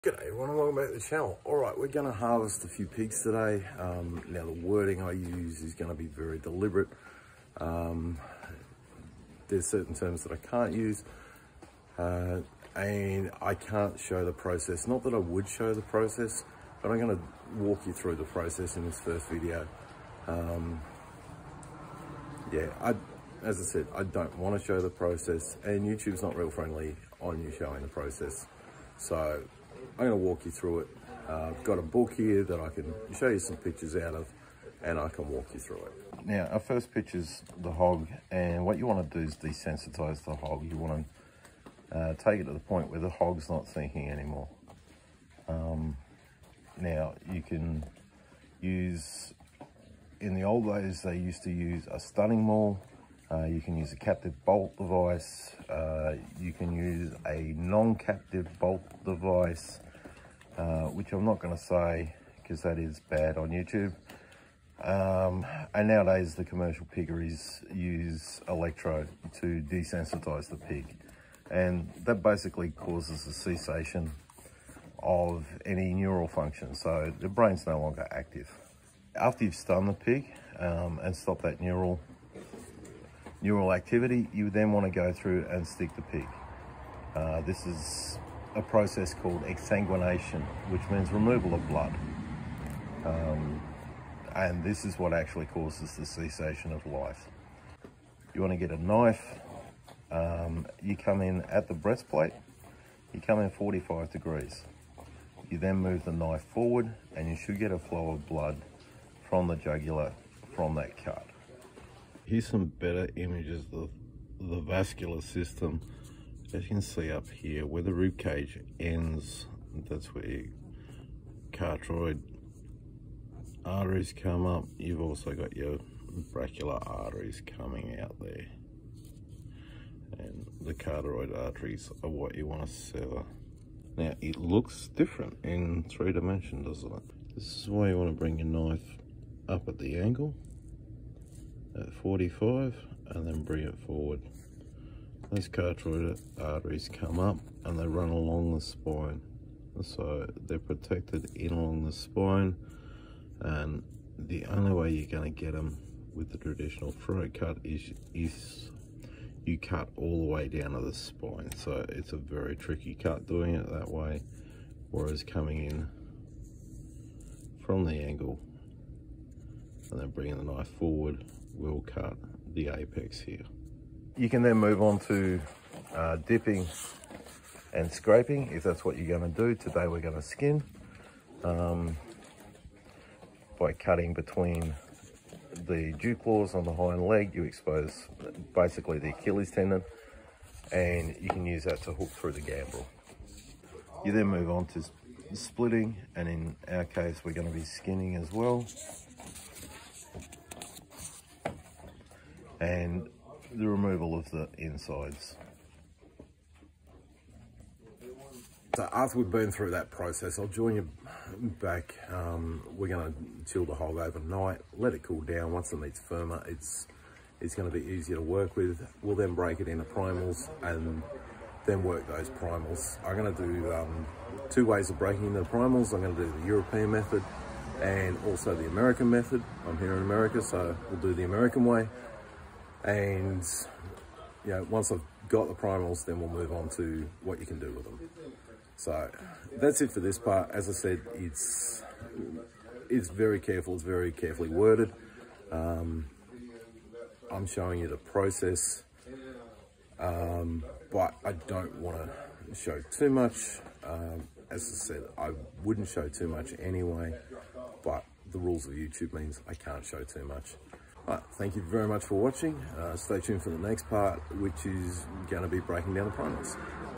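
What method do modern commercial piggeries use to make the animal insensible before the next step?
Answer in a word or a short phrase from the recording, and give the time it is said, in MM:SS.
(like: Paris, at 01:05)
electro, at 01:08.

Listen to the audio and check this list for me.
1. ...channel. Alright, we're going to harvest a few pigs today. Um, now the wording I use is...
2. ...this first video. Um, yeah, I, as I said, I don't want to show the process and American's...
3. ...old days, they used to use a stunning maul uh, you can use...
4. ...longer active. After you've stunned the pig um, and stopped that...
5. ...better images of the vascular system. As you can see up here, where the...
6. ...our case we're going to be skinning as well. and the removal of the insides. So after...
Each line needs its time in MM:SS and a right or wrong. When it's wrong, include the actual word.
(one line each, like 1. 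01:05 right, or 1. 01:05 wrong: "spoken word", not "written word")
1. 00:00 right
2. 00:18 wrong: "YouTube", not "American"
3. 00:50 right
4. 01:17 right
5. 01:52 right
6. 03:16 right.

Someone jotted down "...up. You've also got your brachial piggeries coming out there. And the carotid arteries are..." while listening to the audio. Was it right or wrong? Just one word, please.
wrong.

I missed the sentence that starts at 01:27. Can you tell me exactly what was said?
Uh, this is a process called exsanguination, which means removal of blood.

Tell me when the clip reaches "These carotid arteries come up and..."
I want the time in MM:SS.
02:25.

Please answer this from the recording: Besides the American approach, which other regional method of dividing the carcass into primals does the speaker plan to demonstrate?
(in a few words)
European method.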